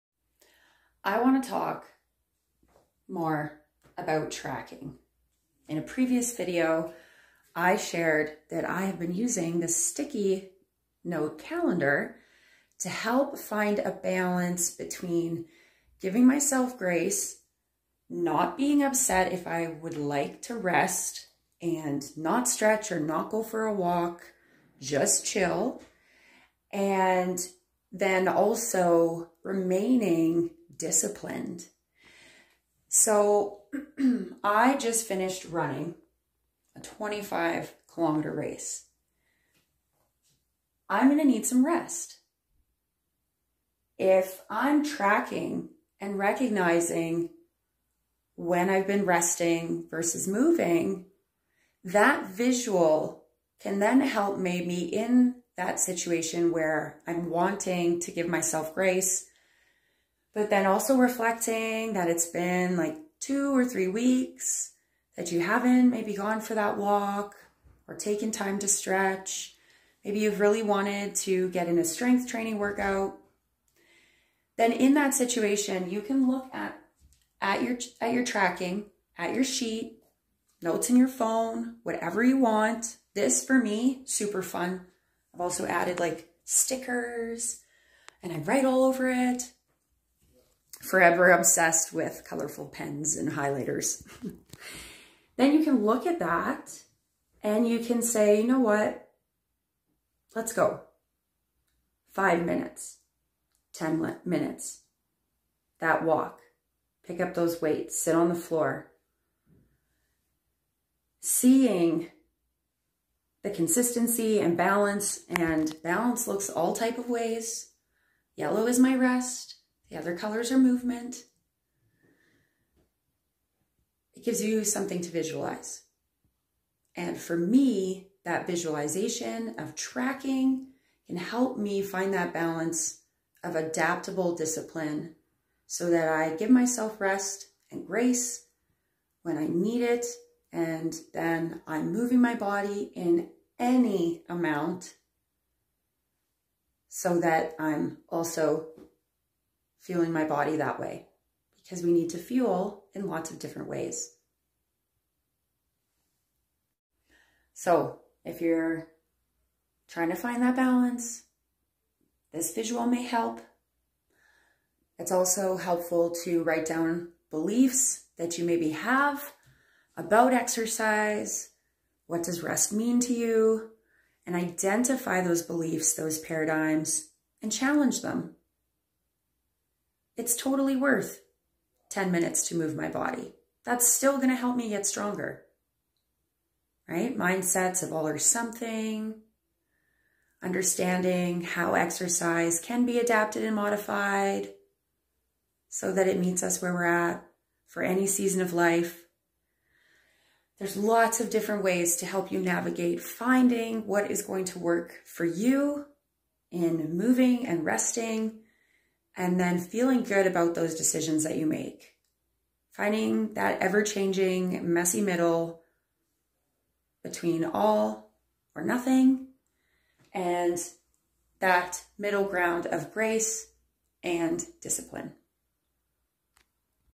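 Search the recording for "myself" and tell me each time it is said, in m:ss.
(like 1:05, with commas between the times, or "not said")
0:16, 0:58, 2:16.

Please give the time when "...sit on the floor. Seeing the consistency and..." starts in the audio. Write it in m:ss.
1:48.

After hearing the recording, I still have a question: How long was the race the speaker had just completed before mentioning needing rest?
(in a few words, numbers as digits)
25 kilometers.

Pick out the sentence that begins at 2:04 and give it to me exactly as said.
It gives you something to visualize.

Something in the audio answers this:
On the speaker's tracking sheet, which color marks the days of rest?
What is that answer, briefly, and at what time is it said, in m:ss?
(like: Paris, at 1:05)
Yellow, at 1:58.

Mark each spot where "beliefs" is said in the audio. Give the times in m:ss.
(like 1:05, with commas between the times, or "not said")
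2:47, 2:55.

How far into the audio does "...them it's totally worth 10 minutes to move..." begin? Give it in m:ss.
2:58.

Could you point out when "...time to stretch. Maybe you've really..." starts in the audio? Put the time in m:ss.
1:08.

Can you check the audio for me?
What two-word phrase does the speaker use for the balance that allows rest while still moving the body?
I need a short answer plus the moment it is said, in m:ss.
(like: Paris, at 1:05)
adaptable discipline, at 2:13.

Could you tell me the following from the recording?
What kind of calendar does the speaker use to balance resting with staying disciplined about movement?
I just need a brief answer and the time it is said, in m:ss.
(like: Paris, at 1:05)
sticky note calendar, at 0:09.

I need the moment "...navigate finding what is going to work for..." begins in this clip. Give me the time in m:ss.
3:22.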